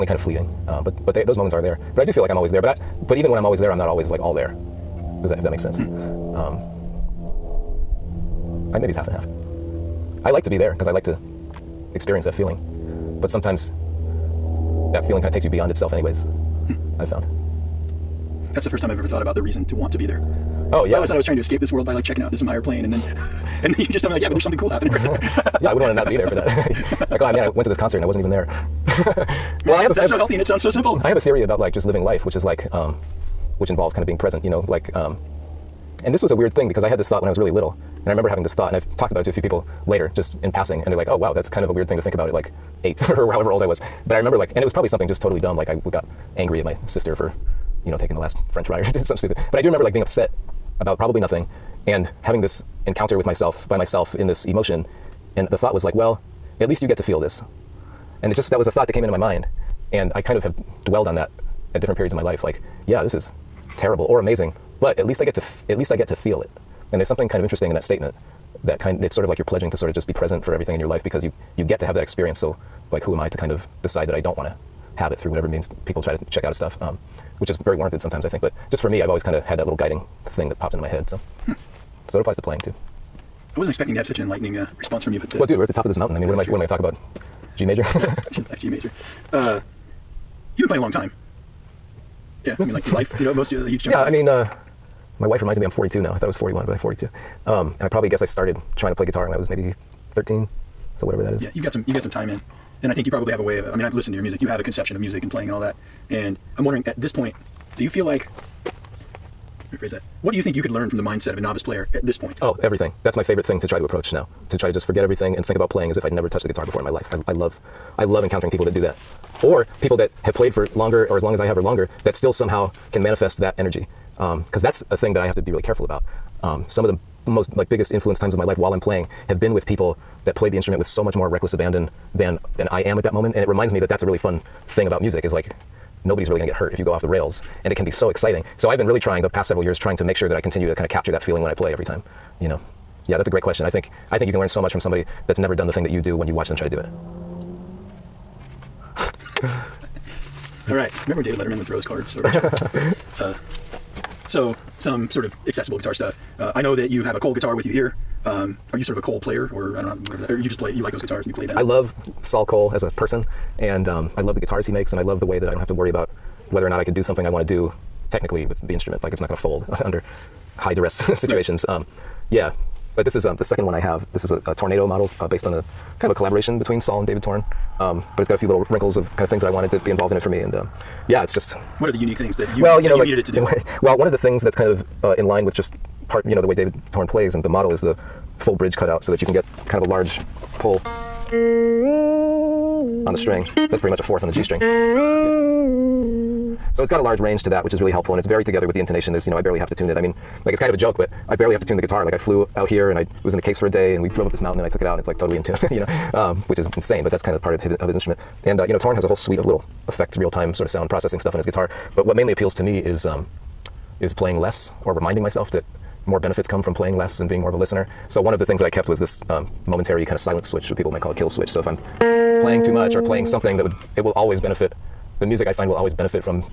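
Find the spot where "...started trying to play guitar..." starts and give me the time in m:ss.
1:38.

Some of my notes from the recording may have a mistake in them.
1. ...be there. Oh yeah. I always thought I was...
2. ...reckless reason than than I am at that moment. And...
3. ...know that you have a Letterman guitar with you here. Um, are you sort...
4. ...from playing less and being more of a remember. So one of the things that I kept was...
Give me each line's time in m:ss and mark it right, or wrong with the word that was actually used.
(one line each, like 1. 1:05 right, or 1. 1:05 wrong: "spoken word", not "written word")
1. 0:19 right
2. 2:11 wrong: "abandon", not "reason"
3. 2:36 wrong: "Koll", not "Letterman"
4. 3:36 wrong: "listener", not "remember".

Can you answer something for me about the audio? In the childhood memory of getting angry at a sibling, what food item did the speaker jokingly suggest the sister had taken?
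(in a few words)
the last French fry.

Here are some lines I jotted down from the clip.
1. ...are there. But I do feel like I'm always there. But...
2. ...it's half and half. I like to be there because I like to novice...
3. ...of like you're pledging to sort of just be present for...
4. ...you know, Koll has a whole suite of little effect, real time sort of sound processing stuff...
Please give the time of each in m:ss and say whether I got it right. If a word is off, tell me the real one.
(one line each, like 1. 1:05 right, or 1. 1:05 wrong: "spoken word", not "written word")
1. 0:01 right
2. 0:08 wrong: "experience", not "novice"
3. 1:09 right
4. 3:28 wrong: "Torn", not "Koll".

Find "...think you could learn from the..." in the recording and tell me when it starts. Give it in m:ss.
1:50.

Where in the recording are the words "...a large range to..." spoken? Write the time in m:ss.
3:16.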